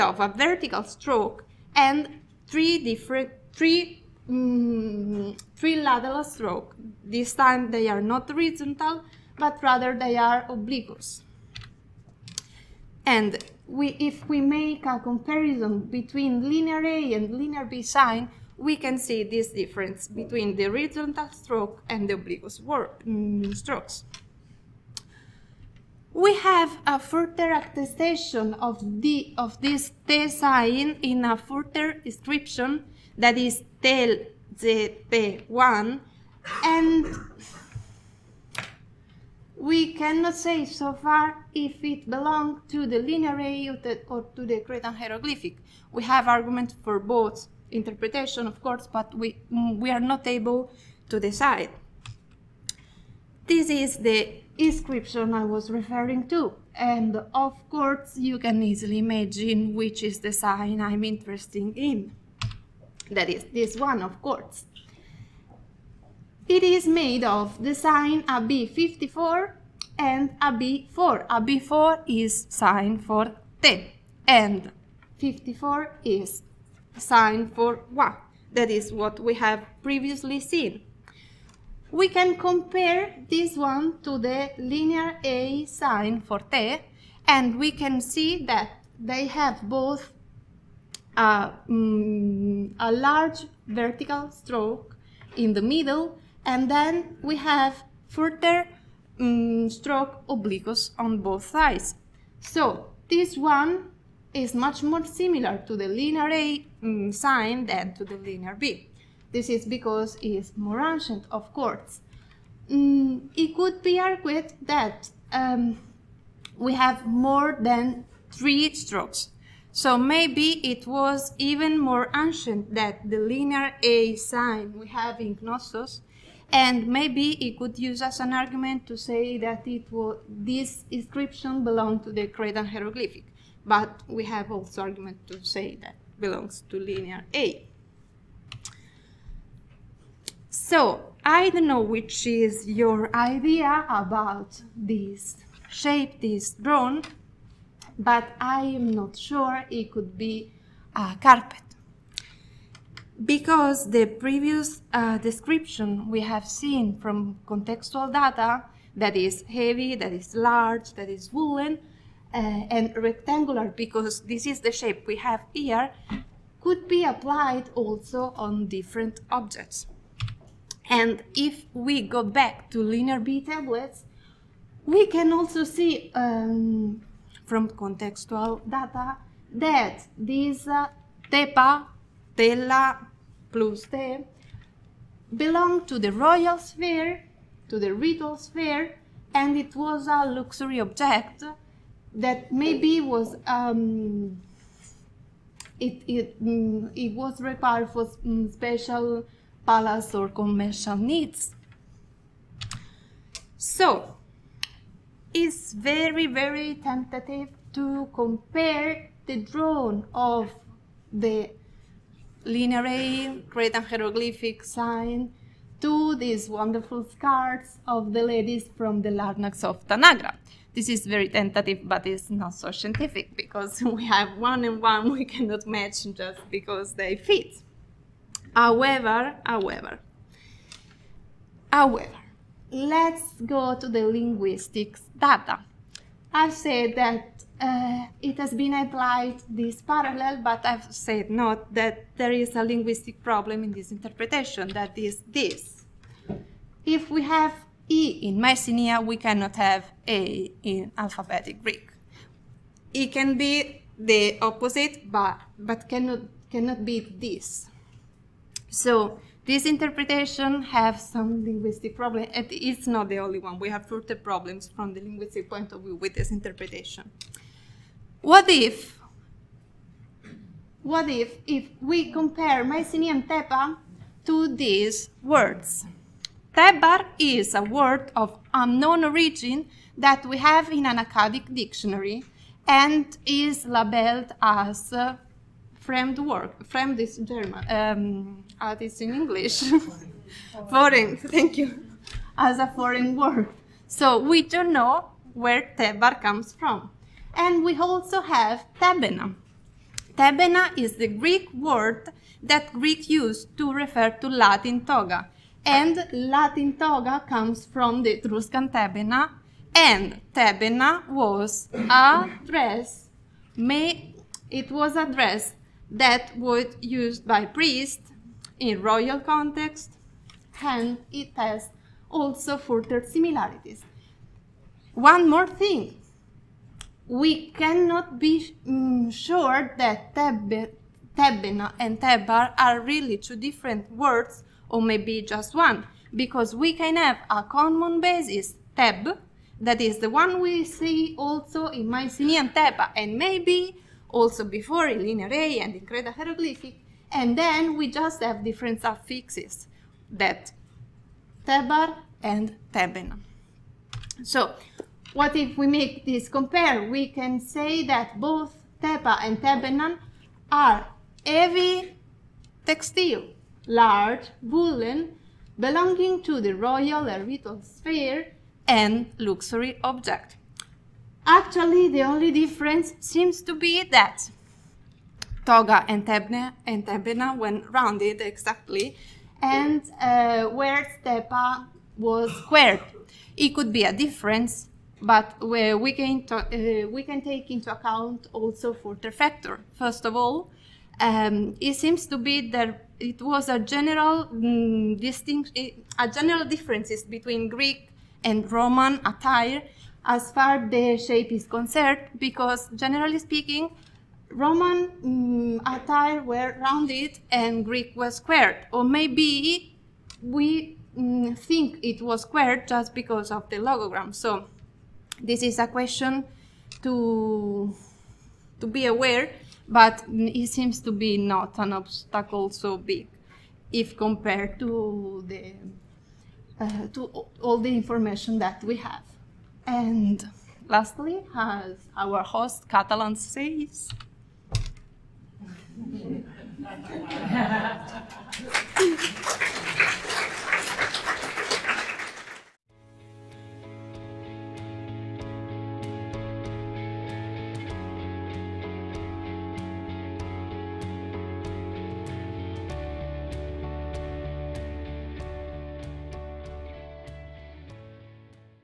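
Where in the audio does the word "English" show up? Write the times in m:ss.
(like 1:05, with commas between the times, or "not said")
4:49.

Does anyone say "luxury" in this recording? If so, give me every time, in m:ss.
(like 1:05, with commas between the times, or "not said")
3:10, 6:09.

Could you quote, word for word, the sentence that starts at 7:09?
And lastly, as our host Catalan says.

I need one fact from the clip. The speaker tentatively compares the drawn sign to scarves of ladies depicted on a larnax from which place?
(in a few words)
Tanagra.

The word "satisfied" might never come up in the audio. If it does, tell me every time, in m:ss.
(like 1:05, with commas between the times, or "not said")
not said.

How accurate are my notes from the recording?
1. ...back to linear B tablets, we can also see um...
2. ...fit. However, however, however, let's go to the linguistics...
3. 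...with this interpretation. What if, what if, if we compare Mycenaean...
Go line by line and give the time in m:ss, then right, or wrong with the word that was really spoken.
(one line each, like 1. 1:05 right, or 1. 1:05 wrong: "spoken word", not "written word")
1. 2:52 right
2. 3:47 right
3. 4:25 right.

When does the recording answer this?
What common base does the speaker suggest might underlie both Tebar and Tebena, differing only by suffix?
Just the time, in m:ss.
5:38.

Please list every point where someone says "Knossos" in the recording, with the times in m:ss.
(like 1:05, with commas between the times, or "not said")
2:05.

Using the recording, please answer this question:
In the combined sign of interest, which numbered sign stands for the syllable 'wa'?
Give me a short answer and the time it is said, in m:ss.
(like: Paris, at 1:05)
AB54, at 1:15.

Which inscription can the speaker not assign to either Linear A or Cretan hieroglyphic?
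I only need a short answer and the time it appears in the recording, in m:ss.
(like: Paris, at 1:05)
TEL ZP1, at 0:33.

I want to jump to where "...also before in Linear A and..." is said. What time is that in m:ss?
5:44.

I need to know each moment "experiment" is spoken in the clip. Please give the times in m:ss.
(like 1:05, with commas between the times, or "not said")
not said.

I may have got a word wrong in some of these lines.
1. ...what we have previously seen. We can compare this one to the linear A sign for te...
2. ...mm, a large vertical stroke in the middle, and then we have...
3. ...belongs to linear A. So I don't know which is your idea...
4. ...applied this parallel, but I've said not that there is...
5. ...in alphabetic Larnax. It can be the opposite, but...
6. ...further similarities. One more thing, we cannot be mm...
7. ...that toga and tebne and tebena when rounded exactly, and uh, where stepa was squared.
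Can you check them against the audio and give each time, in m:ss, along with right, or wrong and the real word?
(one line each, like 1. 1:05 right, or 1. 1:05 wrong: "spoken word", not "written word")
1. 1:18 right
2. 1:31 right
3. 2:16 right
4. 3:58 right
5. 4:10 wrong: "Greek", not "Larnax"
6. 5:22 right
7. 6:13 right.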